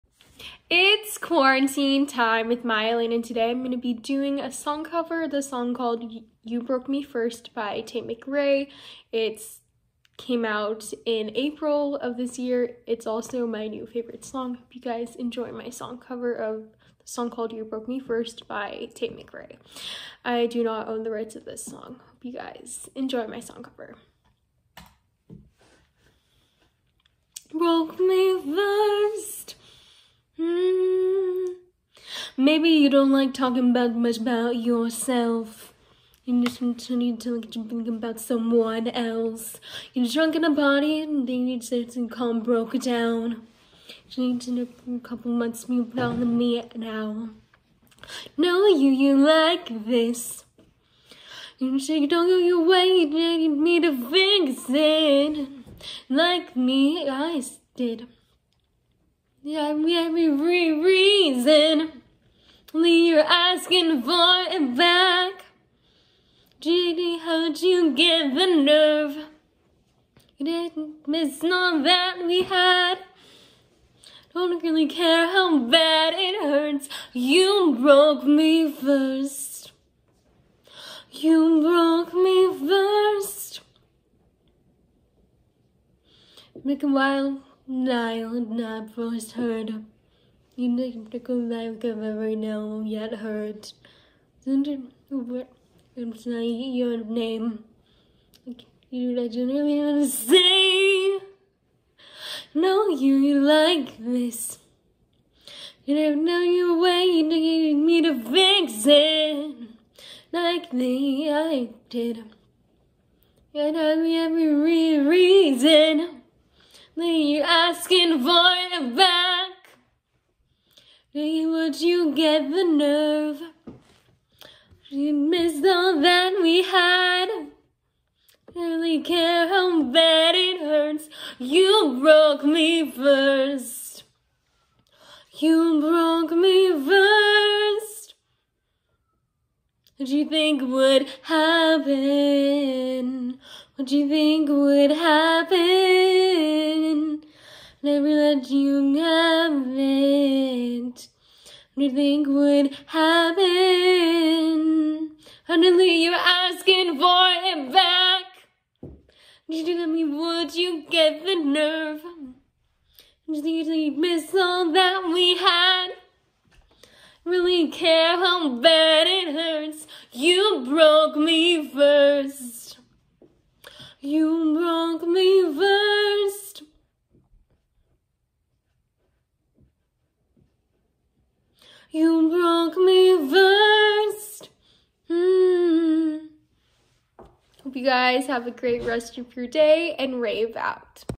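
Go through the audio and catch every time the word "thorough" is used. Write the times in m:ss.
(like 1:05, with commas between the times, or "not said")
not said.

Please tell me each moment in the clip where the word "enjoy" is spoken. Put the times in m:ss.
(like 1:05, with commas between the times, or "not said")
0:15, 0:22.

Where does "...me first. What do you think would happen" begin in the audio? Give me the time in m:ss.
2:16.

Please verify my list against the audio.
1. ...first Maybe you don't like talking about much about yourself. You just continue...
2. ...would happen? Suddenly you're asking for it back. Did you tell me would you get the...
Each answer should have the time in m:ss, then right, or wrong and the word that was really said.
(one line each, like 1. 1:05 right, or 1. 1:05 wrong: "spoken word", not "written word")
1. 0:28 right
2. 2:32 right.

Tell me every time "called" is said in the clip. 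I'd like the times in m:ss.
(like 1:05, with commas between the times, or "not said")
0:05, 0:17.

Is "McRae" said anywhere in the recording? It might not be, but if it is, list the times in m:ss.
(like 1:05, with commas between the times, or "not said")
0:08, 0:19.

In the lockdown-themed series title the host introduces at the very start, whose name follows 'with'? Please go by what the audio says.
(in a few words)
Maya.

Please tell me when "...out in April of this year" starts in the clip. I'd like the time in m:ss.
0:10.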